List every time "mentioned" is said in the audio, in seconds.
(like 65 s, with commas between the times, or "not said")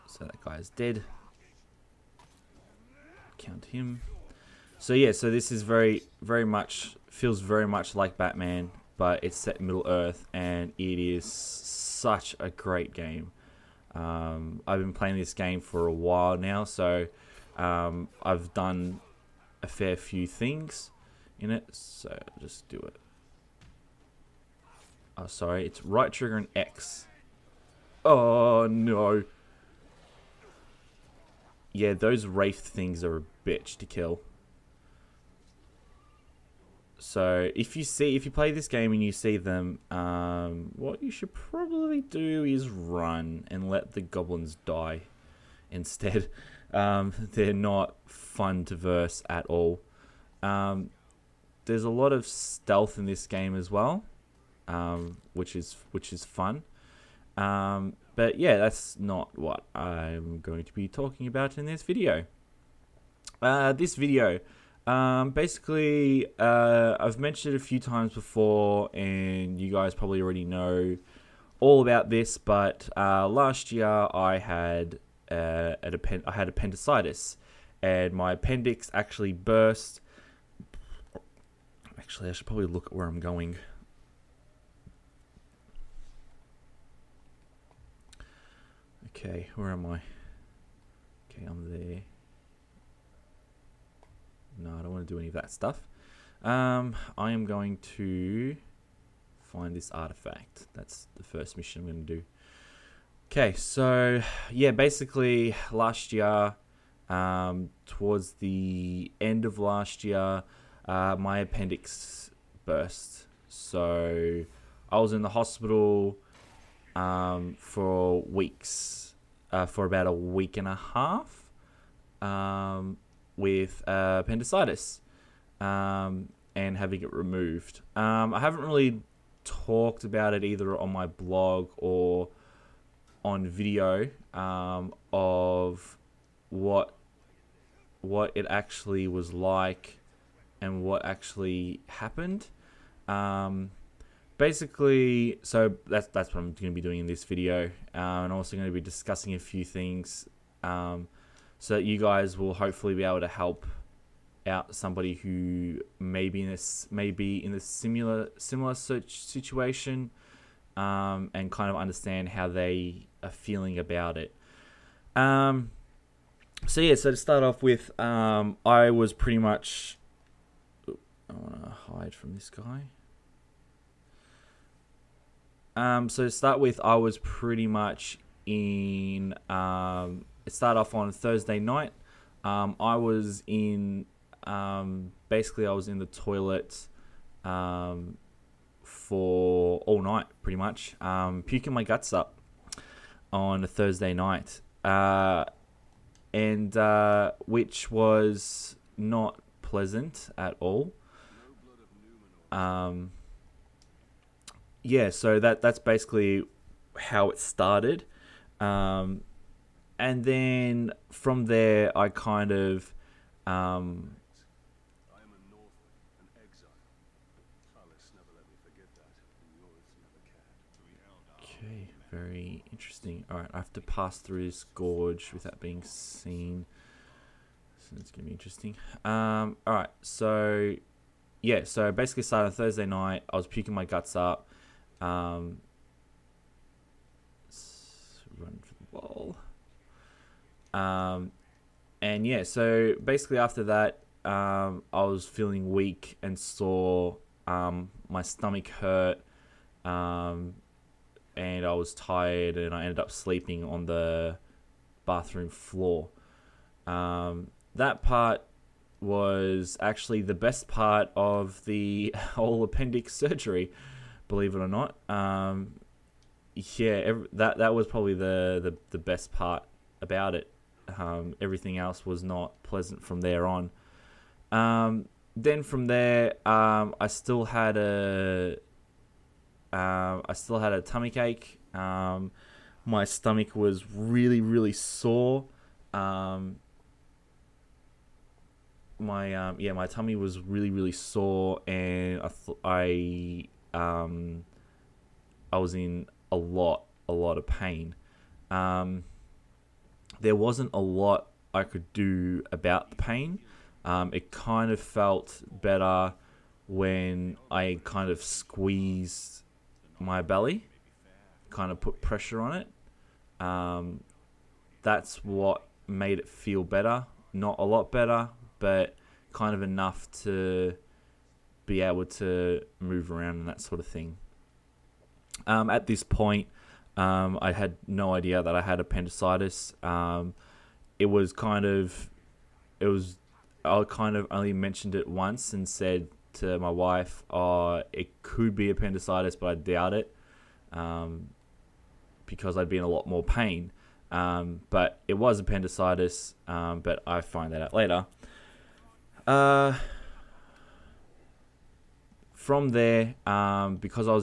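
67 s, 334 s.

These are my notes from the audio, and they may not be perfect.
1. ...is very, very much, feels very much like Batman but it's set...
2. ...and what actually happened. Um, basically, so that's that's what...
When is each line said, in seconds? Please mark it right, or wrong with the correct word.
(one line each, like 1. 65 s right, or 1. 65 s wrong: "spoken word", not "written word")
1. 5 s right
2. 140 s right.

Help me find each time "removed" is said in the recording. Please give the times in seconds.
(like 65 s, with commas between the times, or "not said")
127 s.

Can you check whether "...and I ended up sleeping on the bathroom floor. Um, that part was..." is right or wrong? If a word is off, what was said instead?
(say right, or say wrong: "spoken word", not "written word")
right.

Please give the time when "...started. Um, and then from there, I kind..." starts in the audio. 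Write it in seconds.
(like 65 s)
207 s.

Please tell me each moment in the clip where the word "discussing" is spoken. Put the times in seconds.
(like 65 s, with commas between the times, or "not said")
148 s.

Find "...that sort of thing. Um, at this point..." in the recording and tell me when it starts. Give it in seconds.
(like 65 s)
323 s.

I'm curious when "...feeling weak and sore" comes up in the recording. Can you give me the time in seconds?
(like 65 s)
245 s.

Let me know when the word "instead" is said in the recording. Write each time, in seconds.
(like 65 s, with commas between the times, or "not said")
45 s.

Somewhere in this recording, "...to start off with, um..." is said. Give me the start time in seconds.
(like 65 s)
167 s.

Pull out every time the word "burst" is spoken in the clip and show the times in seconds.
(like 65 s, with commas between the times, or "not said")
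79 s, 112 s.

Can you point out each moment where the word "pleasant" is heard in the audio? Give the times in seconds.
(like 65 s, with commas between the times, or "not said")
199 s, 272 s.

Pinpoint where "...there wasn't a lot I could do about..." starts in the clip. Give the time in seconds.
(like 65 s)
300 s.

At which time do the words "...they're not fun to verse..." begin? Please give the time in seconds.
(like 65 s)
47 s.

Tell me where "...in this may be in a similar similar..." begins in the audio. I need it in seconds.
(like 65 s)
156 s.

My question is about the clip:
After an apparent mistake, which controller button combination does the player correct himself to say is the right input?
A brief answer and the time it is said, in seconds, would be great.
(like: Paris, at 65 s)
Right trigger and X, at 25 s.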